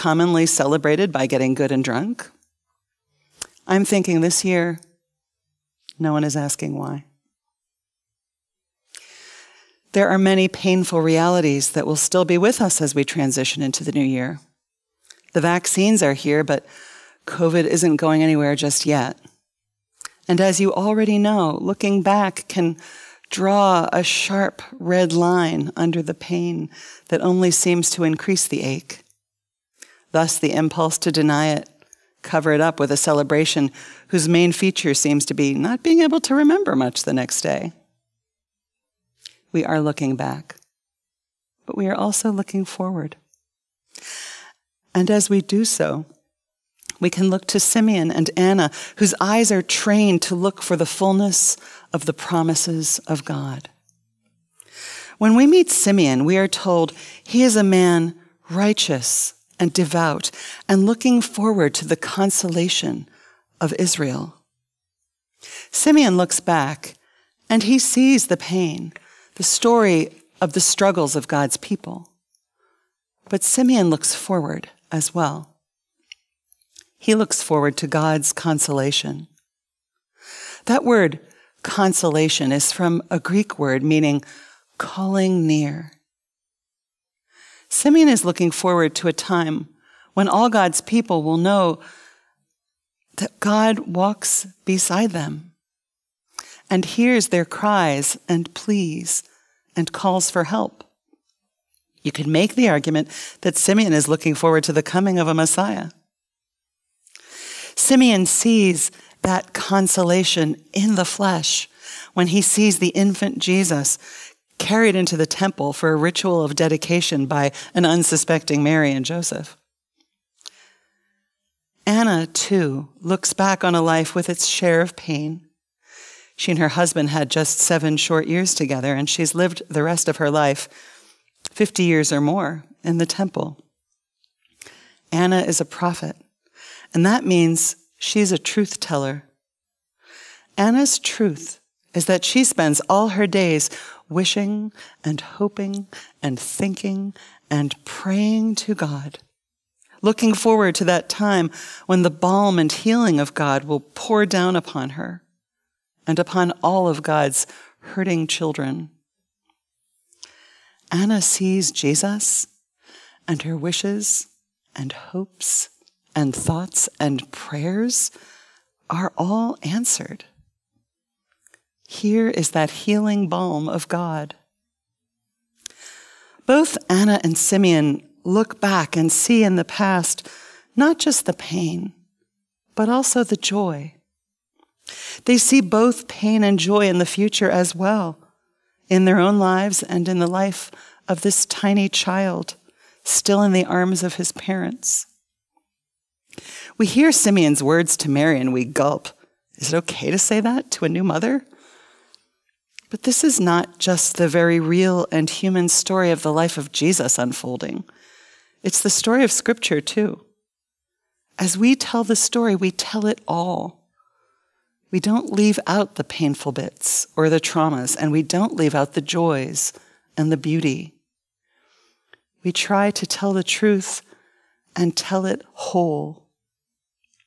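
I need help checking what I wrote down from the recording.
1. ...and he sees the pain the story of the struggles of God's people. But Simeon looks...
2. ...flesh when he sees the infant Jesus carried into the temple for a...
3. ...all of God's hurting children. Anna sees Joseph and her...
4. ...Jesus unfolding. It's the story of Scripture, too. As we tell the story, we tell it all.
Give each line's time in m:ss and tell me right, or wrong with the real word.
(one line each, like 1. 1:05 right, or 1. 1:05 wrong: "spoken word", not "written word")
1. 1:07 right
2. 1:51 right
3. 2:36 wrong: "Jesus", not "Joseph"
4. 3:26 right.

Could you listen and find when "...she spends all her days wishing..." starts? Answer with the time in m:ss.
2:22.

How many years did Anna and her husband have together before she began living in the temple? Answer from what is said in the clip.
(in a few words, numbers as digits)
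7.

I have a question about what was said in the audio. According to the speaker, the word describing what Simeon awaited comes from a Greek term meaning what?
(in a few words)
calling near.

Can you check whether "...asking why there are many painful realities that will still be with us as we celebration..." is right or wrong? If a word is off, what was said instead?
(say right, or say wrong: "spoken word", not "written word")
wrong: "transition", not "celebration".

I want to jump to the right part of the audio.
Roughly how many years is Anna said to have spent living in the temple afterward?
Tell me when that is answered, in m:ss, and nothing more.
2:11.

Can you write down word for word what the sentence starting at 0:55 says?
When we meet Simeon, we are told he is a man righteous and devout and looking forward to the consolation of Israel.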